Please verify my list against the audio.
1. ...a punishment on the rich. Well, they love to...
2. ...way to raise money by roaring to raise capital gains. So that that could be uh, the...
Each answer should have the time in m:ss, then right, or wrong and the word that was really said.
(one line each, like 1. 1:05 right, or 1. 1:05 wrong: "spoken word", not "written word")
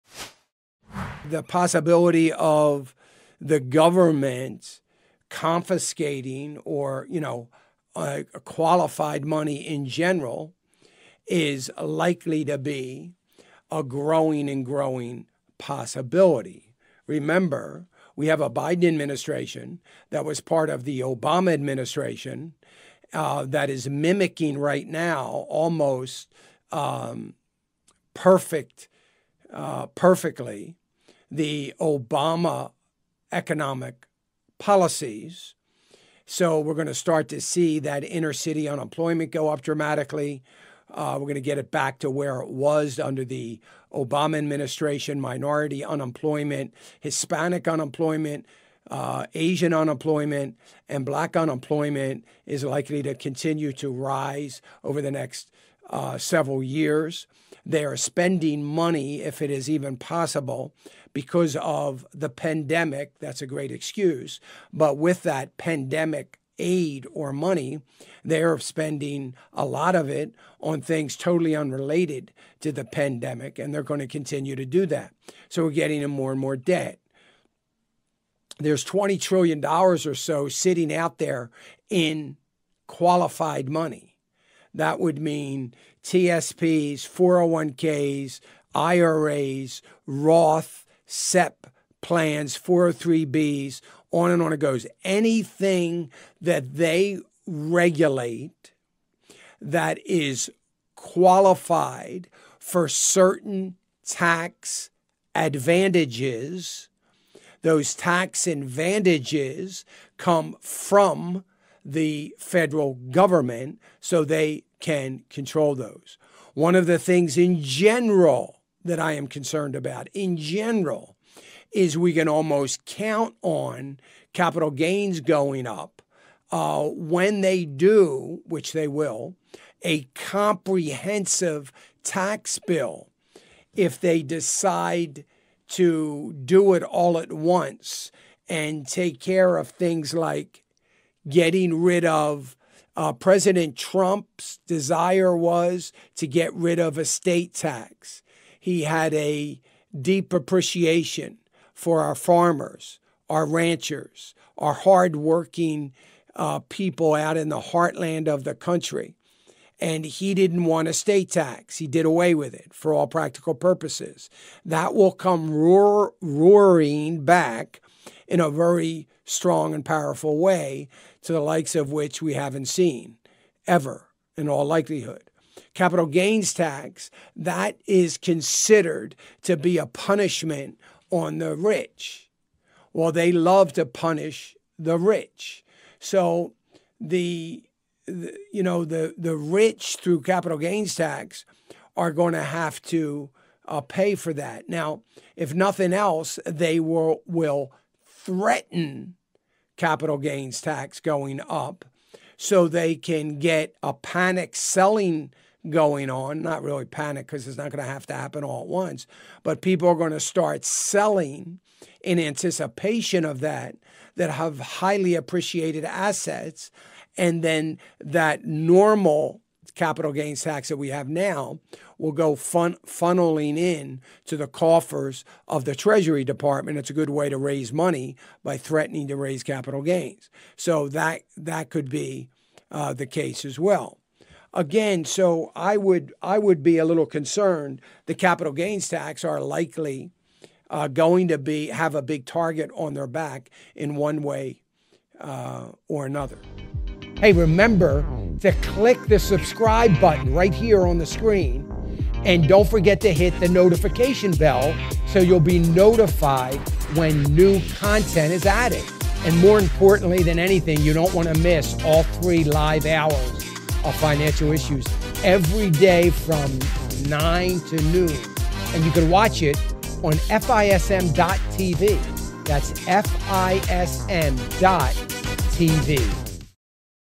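1. 2:59 right
2. 3:47 wrong: "threatening", not "roaring".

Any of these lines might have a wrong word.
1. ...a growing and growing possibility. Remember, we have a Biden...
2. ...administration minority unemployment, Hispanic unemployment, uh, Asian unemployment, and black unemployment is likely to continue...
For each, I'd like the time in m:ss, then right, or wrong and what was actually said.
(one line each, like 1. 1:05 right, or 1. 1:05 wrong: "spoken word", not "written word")
1. 0:13 right
2. 0:44 right.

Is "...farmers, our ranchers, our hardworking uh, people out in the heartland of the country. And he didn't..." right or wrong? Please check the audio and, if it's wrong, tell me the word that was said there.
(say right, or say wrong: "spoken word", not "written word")
right.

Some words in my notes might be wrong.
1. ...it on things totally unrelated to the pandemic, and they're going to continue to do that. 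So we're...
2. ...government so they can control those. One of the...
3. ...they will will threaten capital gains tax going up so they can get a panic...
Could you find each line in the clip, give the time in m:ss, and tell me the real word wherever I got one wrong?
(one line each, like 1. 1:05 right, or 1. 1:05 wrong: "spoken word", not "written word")
1. 1:10 right
2. 1:53 right
3. 3:16 right.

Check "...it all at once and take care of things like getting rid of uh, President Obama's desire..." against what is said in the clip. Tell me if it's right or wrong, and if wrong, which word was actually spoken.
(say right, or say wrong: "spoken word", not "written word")
wrong: "Trump", not "Obama".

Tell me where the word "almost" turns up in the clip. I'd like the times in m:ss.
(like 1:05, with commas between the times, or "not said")
0:25, 2:02.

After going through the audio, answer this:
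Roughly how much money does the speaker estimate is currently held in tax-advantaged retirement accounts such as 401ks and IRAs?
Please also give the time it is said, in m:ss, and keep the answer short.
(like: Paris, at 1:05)
$20 trillion, at 1:18.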